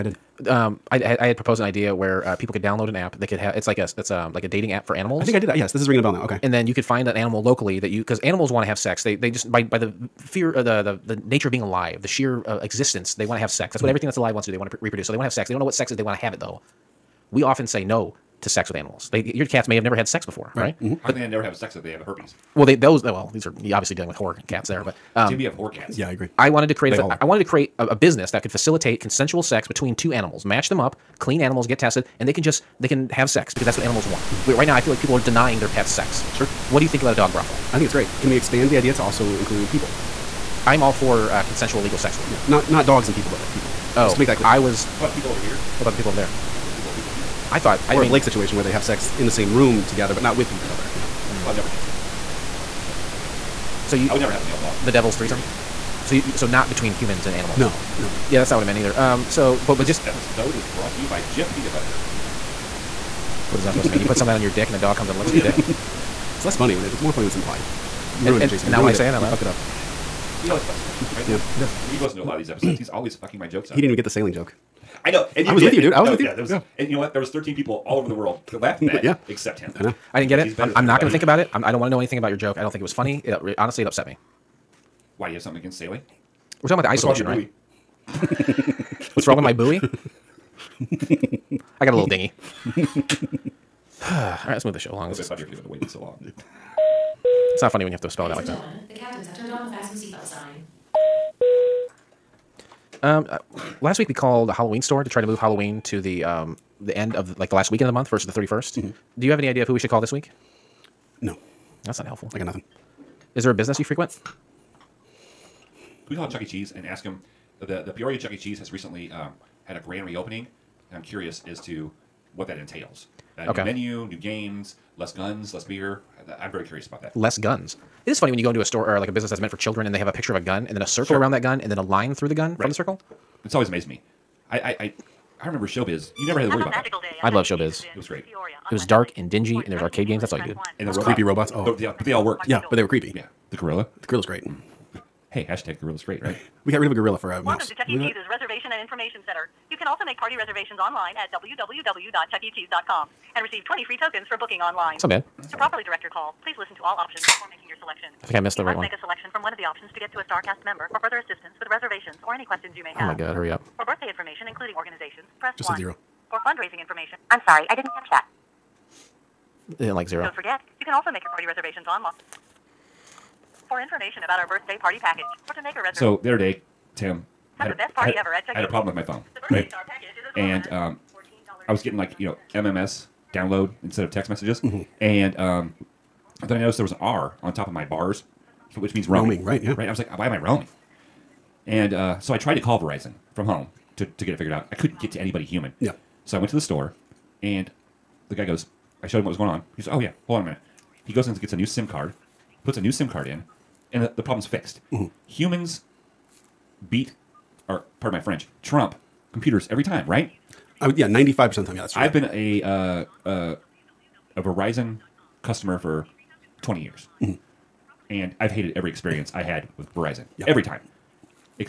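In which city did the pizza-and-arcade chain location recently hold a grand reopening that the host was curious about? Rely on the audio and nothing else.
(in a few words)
Peoria.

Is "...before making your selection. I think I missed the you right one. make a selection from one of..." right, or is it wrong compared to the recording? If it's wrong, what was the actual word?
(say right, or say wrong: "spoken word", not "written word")
right.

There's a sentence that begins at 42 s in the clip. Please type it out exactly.
Yeah, not not dogs and people, but like people and people.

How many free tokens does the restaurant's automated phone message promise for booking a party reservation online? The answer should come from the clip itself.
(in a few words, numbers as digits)
20.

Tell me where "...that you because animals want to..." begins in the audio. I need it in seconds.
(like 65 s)
7 s.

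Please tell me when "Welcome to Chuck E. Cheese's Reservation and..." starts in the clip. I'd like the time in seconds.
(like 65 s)
147 s.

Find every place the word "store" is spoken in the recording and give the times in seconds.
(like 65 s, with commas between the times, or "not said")
104 s, 128 s, 196 s.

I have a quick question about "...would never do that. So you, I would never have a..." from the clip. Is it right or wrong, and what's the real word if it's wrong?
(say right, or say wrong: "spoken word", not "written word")
right.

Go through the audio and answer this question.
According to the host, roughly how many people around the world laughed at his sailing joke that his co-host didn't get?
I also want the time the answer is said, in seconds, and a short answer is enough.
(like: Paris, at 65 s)
13, at 77 s.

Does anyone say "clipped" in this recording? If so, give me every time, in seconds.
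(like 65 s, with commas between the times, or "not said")
not said.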